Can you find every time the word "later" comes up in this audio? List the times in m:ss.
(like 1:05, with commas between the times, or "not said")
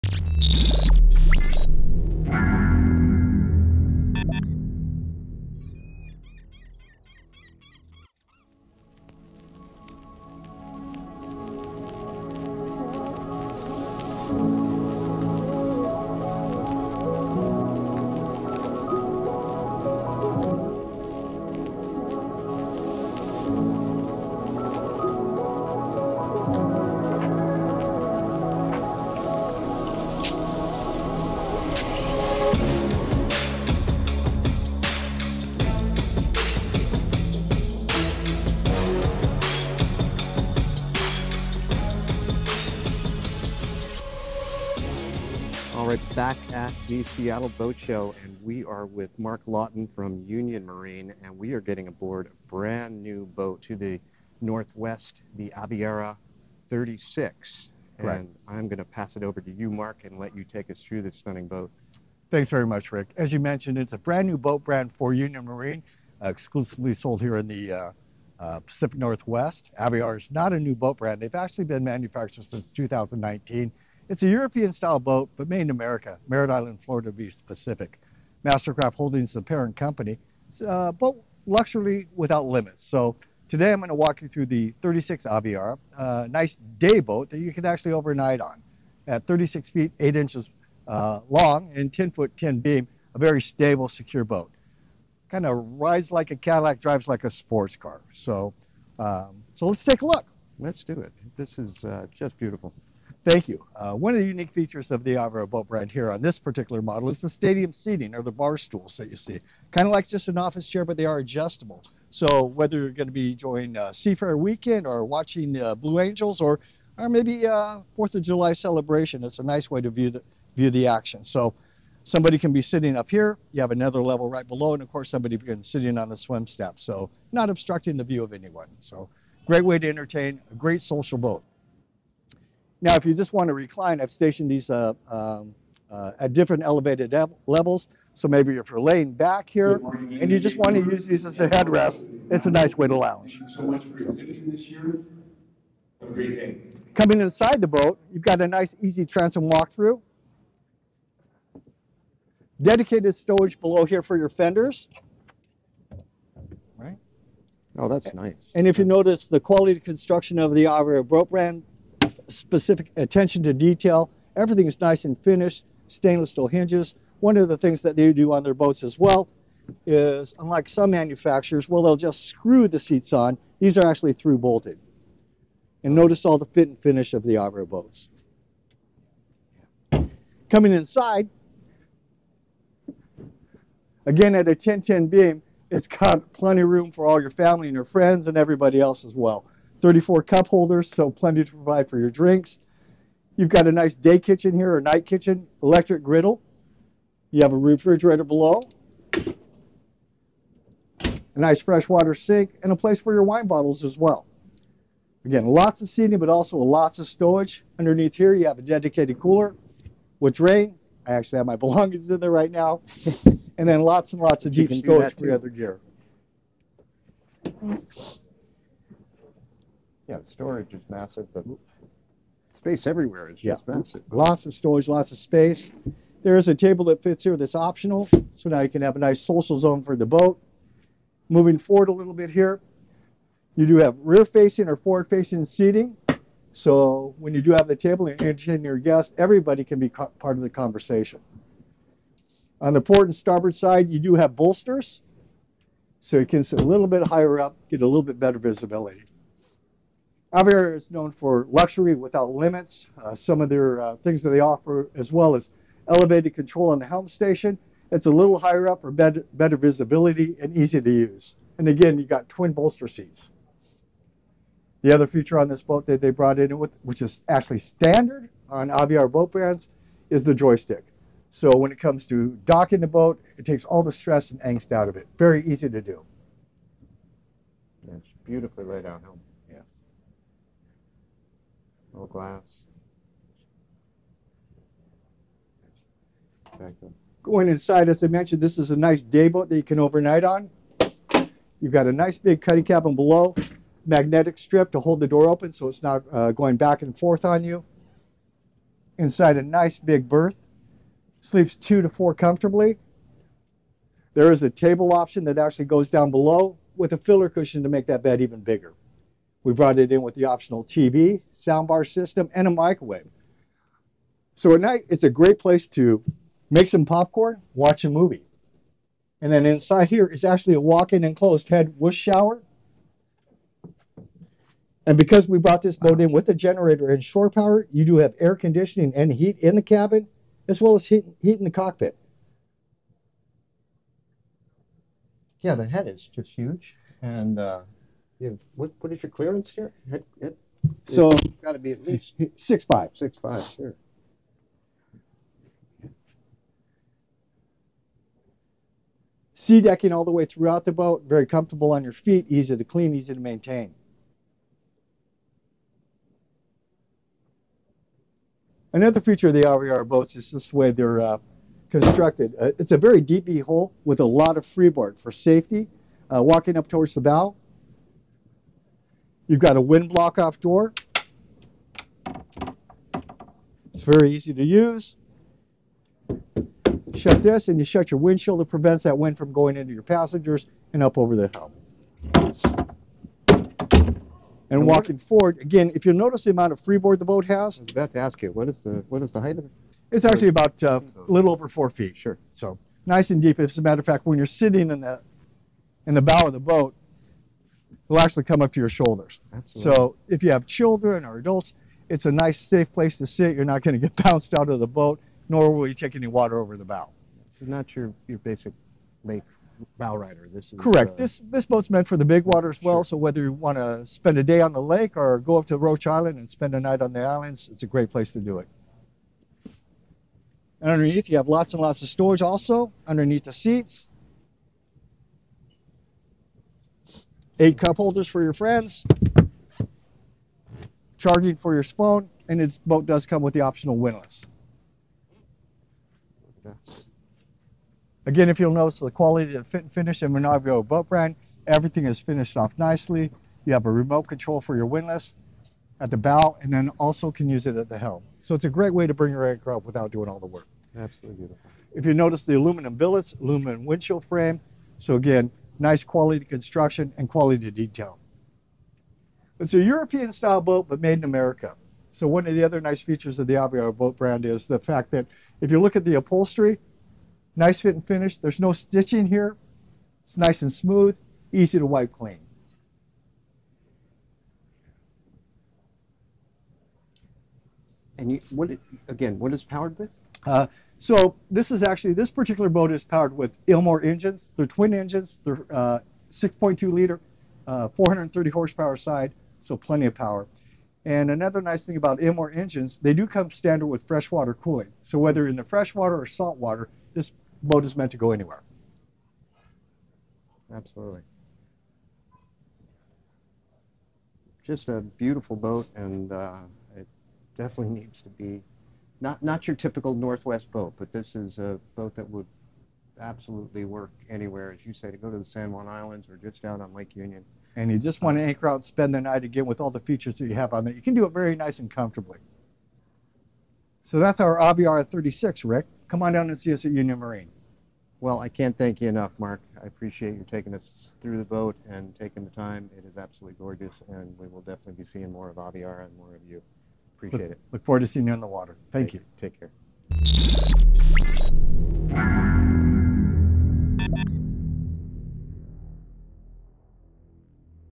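not said.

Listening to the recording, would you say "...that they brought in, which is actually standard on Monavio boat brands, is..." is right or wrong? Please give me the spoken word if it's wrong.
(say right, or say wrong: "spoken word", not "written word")
wrong: "Aviara", not "Monavio".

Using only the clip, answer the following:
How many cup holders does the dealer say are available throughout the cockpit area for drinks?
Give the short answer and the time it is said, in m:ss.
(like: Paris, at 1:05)
34, at 3:09.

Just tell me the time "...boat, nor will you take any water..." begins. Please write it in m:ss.
6:44.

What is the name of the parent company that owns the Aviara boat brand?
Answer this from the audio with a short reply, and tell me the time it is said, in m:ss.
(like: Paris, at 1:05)
Mastercraft Holdings, at 1:18.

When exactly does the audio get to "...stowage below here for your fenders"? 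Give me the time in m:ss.
2:33.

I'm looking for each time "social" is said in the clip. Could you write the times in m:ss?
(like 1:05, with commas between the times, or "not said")
2:10, 3:49.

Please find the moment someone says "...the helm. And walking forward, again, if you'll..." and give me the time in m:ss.
6:21.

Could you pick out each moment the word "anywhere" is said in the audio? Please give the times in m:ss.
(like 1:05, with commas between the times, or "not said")
8:18, 8:34.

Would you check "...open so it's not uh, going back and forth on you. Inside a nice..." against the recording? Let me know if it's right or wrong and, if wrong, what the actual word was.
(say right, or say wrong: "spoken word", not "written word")
right.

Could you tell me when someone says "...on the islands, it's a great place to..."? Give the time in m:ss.
6:56.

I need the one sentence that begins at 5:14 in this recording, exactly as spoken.
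So at night, it's a great place to make some popcorn, watch a movie.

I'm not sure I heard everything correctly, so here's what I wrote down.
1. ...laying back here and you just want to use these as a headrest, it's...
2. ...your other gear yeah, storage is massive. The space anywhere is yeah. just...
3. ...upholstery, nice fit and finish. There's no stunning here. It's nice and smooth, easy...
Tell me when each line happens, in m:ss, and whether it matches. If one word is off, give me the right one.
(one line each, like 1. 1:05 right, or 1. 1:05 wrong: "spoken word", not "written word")
1. 2:18 right
2. 3:35 wrong: "everywhere", not "anywhere"
3. 7:45 wrong: "stitching", not "stunning".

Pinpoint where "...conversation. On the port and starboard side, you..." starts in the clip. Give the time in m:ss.
4:00.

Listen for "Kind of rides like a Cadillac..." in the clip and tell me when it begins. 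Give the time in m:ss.
1:35.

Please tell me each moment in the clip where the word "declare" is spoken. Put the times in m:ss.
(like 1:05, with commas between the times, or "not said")
not said.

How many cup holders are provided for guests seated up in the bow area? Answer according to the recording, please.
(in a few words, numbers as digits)
8.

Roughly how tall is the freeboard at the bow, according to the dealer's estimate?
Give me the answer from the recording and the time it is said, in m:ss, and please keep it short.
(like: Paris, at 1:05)
A little over 4 feet, at 6:31.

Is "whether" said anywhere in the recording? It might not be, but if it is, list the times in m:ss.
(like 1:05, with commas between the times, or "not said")
1:52, 6:52, 8:14.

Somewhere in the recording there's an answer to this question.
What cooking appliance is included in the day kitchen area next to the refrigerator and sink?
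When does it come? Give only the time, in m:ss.
3:15.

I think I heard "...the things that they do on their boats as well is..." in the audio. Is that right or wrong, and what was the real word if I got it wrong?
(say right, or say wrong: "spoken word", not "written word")
right.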